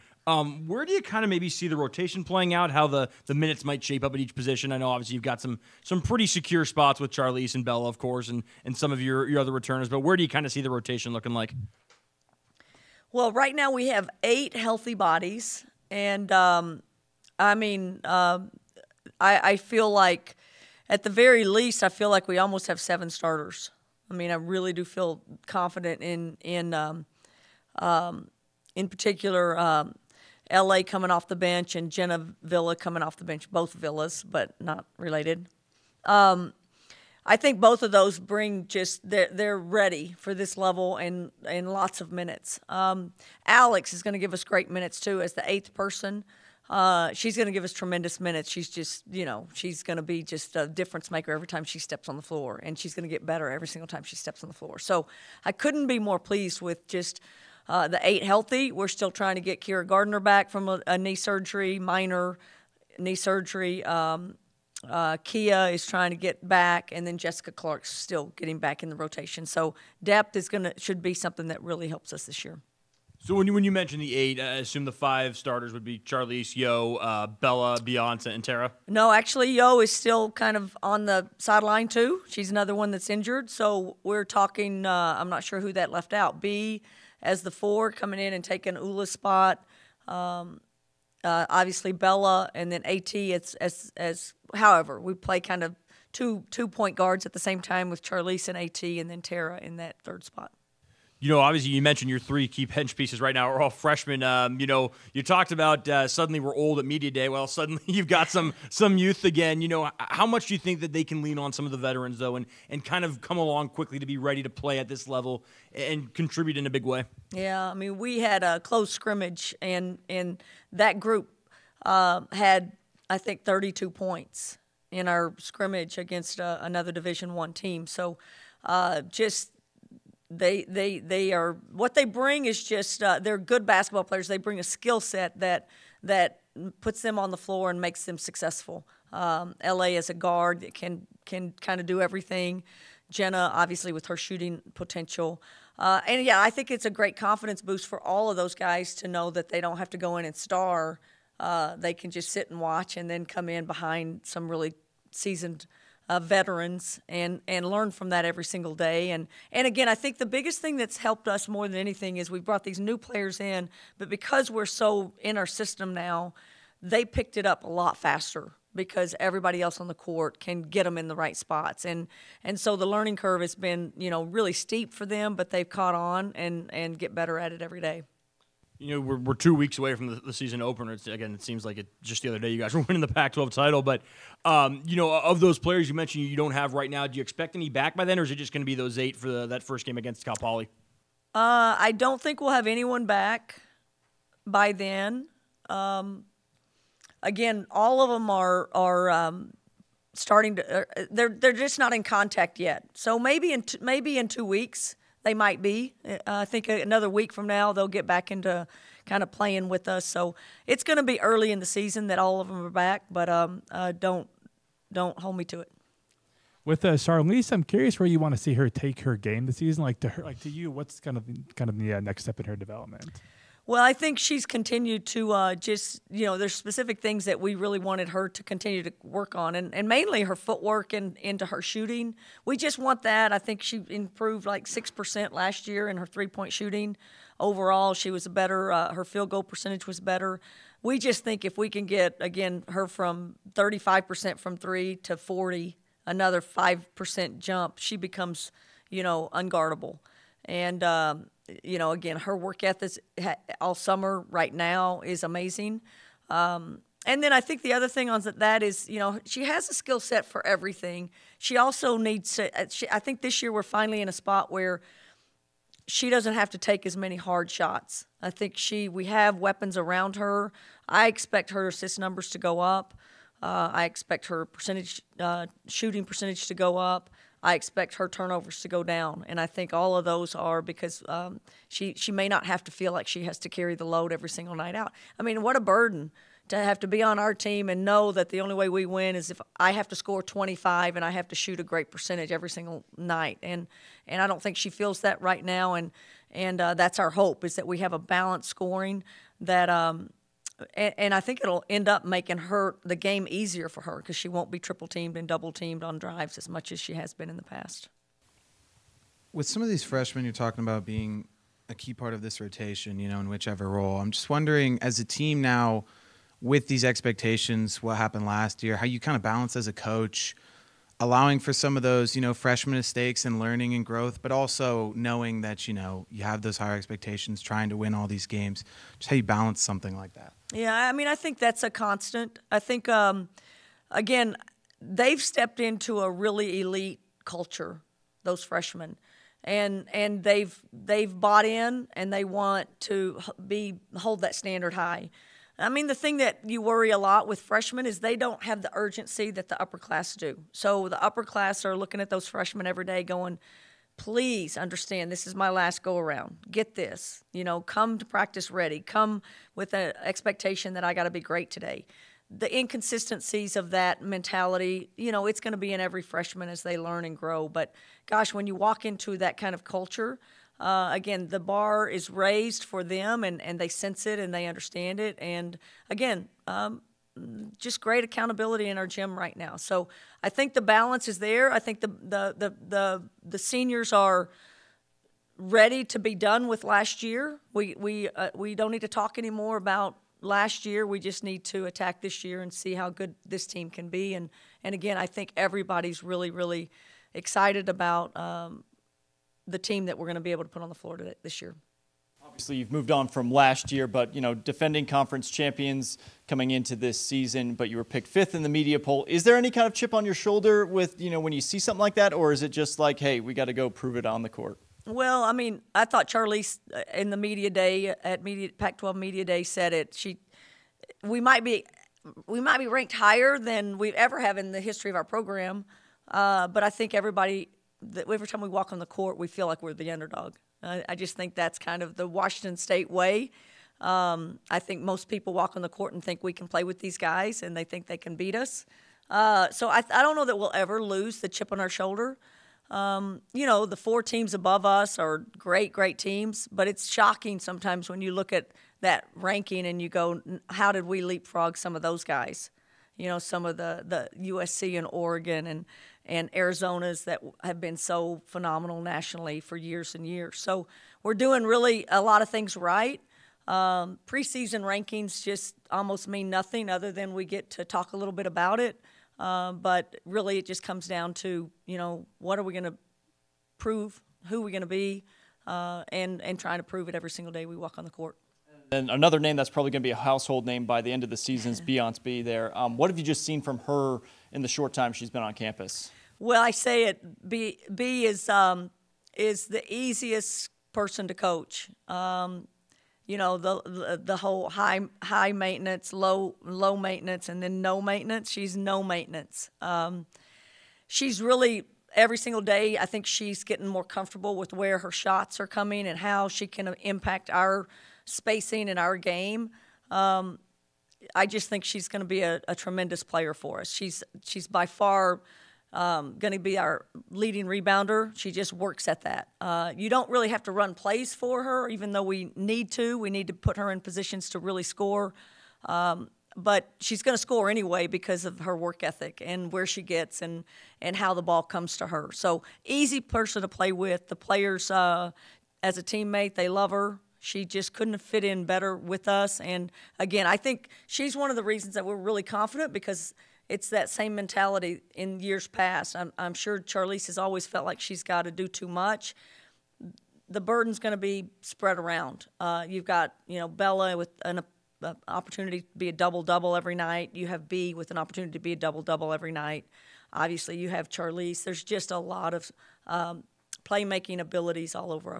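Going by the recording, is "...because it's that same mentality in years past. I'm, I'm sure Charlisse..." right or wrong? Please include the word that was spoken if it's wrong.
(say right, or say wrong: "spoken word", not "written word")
right.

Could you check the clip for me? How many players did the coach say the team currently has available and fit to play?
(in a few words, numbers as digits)
8.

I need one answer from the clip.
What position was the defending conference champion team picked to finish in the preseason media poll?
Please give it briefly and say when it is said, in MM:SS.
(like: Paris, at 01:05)
fifth, at 06:48.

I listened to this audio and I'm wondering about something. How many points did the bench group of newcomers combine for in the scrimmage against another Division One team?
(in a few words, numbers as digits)
32.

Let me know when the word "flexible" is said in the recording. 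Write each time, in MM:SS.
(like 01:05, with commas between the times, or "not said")
not said.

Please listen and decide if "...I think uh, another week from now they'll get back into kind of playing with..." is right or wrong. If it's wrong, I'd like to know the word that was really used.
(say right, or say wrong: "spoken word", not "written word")
right.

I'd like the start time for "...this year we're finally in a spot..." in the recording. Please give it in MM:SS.
04:23.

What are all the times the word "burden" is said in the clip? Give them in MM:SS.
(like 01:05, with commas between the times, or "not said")
04:45, 09:10.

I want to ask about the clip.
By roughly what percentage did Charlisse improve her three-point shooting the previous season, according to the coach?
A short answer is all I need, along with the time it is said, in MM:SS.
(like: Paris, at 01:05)
6%, at 03:54.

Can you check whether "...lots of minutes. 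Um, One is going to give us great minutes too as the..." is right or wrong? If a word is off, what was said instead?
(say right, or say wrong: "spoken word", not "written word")
wrong: "Alex", not "One".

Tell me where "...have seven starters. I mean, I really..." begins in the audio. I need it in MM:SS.
00:22.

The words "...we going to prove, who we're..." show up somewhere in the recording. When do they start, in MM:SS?
07:52.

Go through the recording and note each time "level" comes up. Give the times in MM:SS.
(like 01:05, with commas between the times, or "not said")
00:40, 01:55.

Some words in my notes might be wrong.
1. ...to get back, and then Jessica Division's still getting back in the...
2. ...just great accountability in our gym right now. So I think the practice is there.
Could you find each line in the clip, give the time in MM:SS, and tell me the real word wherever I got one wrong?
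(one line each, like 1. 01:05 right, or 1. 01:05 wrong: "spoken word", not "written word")
1. 01:06 wrong: "Clark", not "Division"
2. 06:17 wrong: "balance", not "practice".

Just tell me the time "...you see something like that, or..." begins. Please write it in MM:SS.
06:51.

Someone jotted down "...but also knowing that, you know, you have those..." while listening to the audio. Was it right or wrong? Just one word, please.
right.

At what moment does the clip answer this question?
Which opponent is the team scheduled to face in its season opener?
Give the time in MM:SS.
03:10.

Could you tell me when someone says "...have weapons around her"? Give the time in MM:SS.
04:29.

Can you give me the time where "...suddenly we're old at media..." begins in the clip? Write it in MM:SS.
01:46.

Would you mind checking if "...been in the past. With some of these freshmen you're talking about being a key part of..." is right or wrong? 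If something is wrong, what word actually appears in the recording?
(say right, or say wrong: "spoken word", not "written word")
right.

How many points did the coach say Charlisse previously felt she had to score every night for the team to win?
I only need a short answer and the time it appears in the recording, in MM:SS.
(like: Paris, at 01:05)
25, at 04:50.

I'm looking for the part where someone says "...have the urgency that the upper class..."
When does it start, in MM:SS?
05:48.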